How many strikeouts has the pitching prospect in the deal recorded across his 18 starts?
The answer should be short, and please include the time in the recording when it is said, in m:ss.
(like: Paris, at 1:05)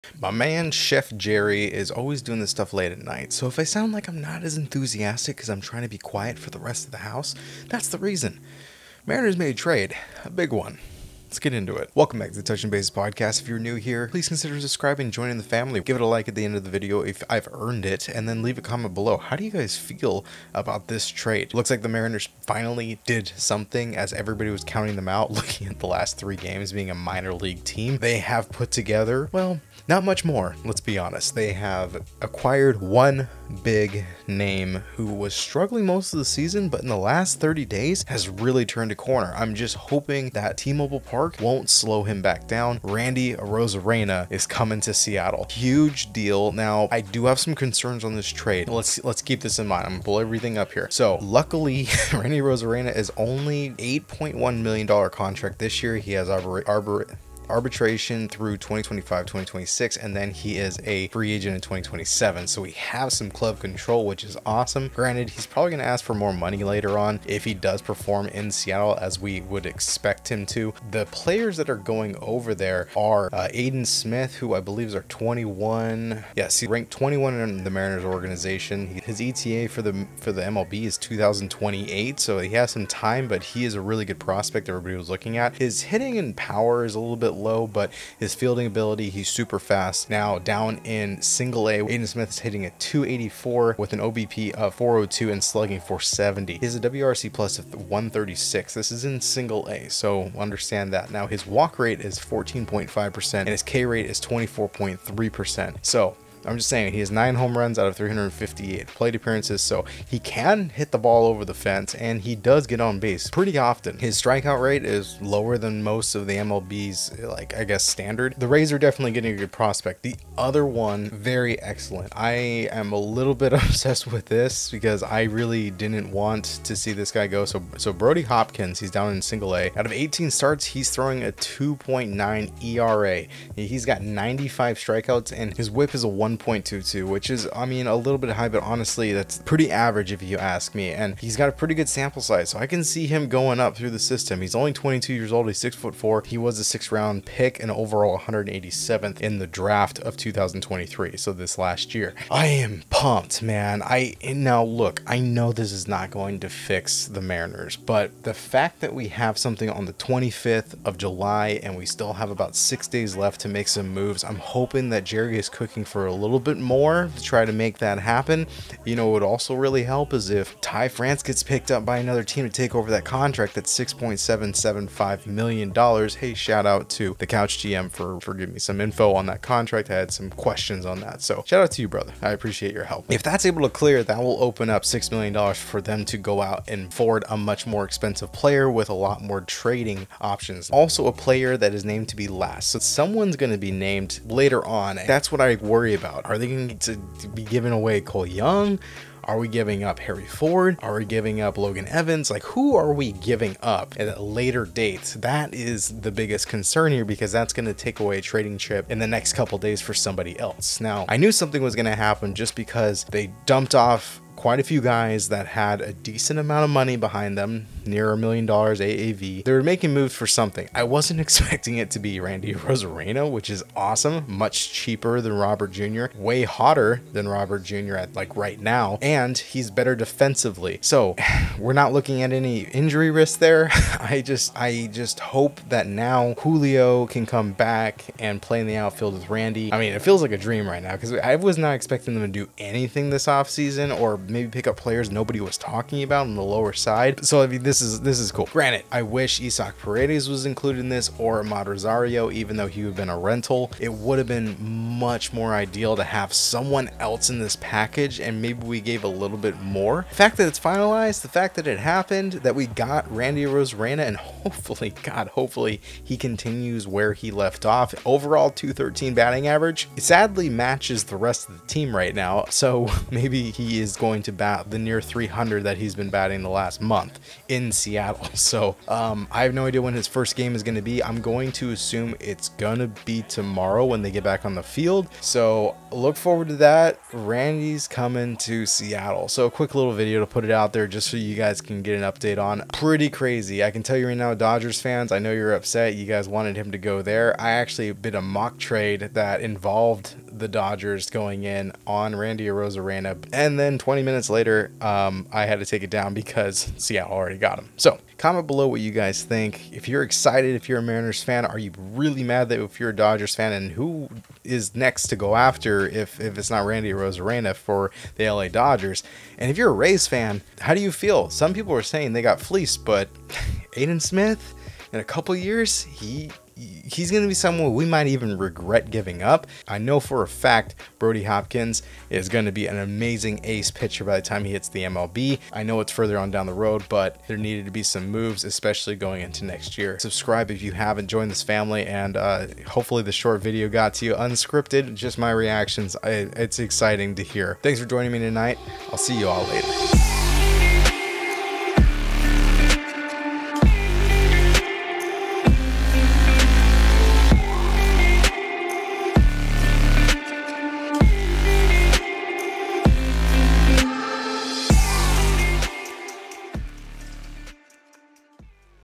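95, at 2:14.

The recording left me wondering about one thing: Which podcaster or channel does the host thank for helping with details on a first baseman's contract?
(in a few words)
the Couch GM.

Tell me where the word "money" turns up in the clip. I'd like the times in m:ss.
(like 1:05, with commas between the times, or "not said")
1:06, 3:36.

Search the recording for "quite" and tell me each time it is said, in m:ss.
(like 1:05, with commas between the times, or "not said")
3:34.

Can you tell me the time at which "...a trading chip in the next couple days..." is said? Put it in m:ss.
3:28.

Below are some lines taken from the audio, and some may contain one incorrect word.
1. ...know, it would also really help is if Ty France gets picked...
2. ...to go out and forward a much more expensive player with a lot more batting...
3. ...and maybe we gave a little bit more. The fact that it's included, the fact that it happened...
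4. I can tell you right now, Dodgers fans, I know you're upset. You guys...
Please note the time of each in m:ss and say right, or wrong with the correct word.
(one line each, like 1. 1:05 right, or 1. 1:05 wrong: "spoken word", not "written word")
1. 2:48 right
2. 3:06 wrong: "trading", not "batting"
3. 4:18 wrong: "finalized", not "included"
4. 4:53 right.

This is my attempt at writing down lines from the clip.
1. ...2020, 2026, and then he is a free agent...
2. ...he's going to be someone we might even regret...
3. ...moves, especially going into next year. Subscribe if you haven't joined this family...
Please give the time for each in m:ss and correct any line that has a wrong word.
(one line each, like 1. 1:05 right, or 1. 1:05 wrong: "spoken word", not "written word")
1. 0:58 wrong: "2025", not "2020"
2. 5:26 right
3. 5:38 right.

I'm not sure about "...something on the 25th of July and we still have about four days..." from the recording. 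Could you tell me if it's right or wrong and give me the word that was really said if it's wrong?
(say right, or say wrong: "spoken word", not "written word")
wrong: "six", not "four".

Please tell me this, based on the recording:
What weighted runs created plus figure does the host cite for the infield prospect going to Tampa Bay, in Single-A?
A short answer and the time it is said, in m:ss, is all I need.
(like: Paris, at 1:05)
136, at 1:37.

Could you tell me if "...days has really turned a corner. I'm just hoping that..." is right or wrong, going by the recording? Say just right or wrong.
right.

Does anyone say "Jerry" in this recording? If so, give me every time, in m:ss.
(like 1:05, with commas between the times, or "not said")
0:01, 2:45.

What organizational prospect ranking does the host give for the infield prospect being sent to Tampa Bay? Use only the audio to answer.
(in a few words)
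21.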